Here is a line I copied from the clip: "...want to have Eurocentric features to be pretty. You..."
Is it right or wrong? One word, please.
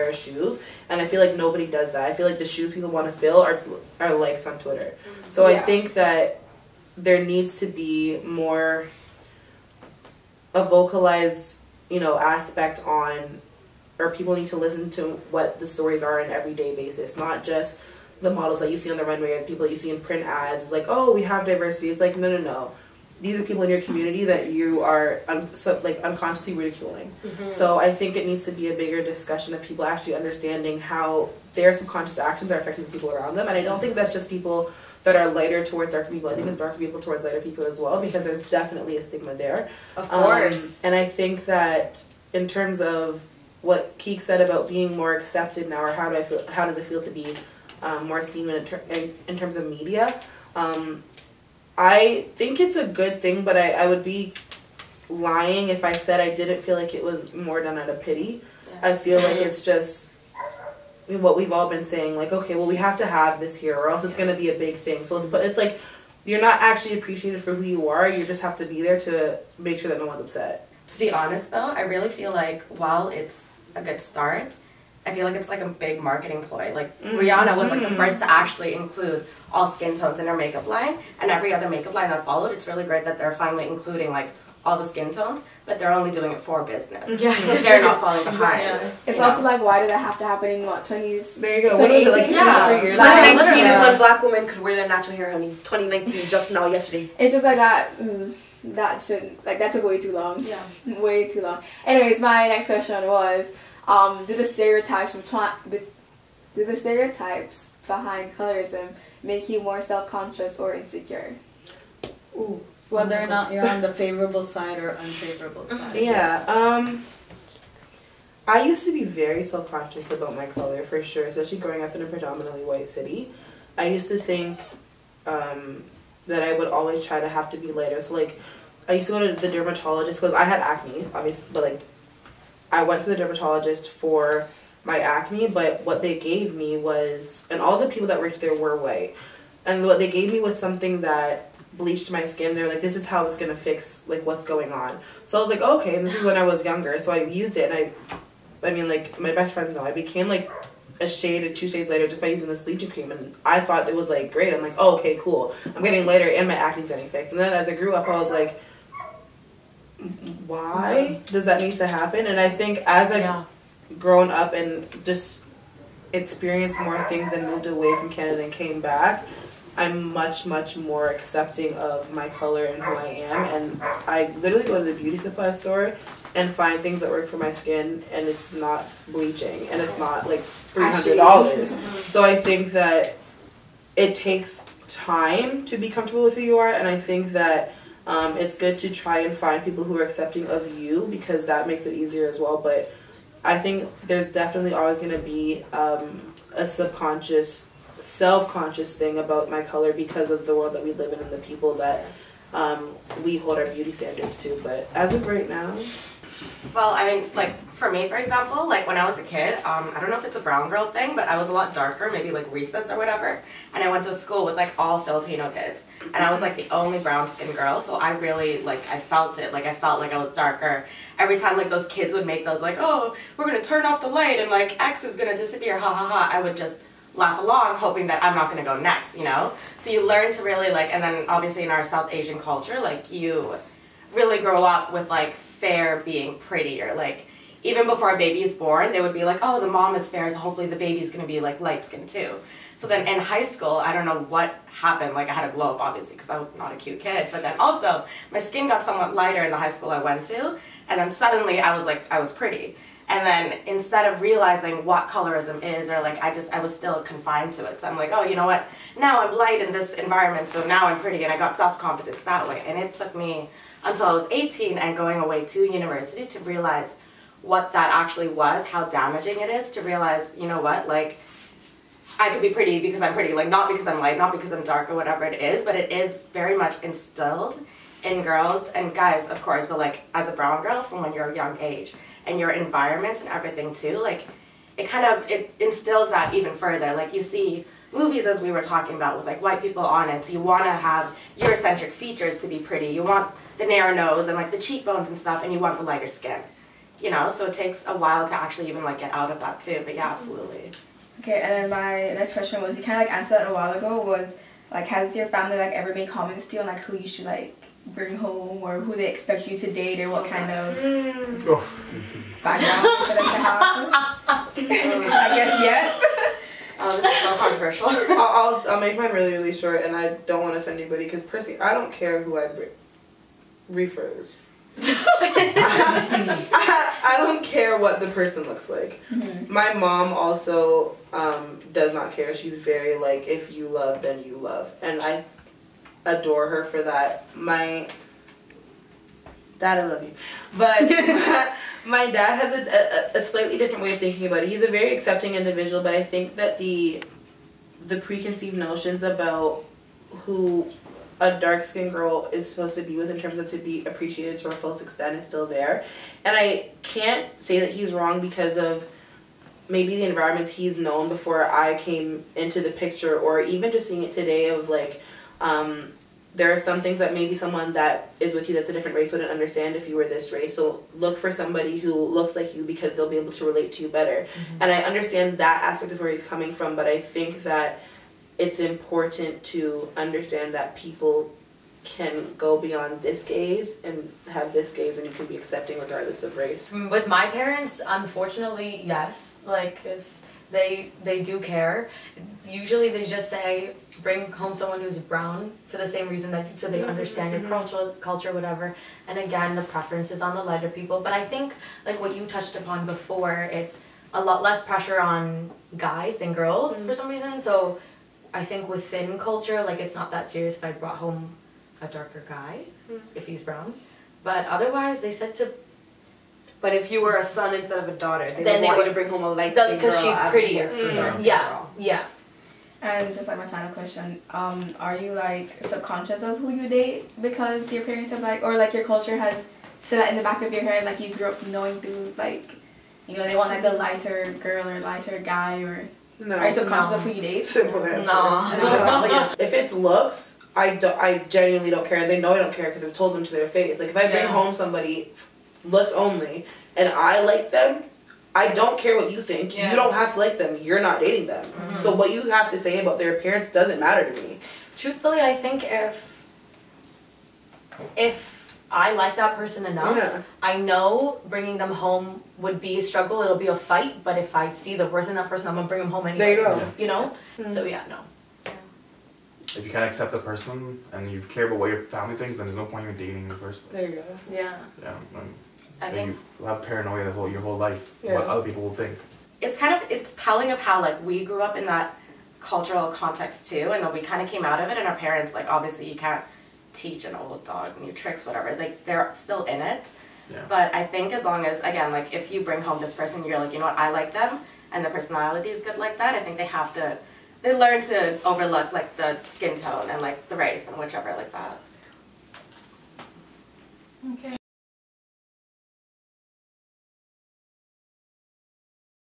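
right.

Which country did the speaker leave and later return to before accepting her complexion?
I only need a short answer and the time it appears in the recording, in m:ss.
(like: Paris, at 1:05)
Canada, at 2:48.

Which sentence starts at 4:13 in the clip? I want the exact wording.
And then instead of realizing what colorism is, or like I just, I was still confined to it.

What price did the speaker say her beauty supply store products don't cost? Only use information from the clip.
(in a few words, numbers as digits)
$300.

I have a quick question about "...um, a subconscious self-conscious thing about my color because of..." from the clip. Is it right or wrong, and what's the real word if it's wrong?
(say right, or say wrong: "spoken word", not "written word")
right.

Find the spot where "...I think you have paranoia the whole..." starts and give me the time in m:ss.
7:55.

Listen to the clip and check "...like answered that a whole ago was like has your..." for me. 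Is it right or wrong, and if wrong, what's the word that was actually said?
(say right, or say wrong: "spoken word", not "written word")
wrong: "while", not "whole".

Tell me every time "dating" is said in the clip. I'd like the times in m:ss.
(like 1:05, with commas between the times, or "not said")
7:30, 7:52.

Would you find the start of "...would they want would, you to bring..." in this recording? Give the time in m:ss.
6:58.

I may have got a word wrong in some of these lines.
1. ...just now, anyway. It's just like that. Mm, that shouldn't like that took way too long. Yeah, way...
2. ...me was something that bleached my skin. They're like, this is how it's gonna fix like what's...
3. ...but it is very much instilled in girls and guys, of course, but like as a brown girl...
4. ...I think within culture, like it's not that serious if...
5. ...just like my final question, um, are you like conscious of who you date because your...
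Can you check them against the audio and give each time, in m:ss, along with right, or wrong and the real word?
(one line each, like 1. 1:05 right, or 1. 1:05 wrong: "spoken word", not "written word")
1. 1:36 wrong: "yesterday", not "anyway"
2. 2:20 right
3. 4:35 right
4. 6:48 right
5. 7:03 wrong: "subconscious", not "conscious".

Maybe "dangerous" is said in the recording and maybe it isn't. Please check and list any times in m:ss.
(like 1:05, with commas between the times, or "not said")
not said.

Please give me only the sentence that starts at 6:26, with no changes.
Mm, with my parents, unfortunately, yes.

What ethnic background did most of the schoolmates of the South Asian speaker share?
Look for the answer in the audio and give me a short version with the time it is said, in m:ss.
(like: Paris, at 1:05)
Filipino, at 3:34.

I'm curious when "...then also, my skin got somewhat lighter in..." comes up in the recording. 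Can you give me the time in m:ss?
4:07.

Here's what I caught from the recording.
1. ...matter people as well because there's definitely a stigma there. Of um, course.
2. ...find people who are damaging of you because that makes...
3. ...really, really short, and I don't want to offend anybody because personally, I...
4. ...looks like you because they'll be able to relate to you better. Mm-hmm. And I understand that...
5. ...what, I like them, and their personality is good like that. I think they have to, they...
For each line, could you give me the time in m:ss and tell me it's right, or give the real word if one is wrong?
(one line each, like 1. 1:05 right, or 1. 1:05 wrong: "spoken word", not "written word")
1. 0:37 wrong: "lighter", not "matter"
2. 3:09 wrong: "accepting", not "damaging"
3. 5:19 right
4. 6:11 right
5. 8:13 right.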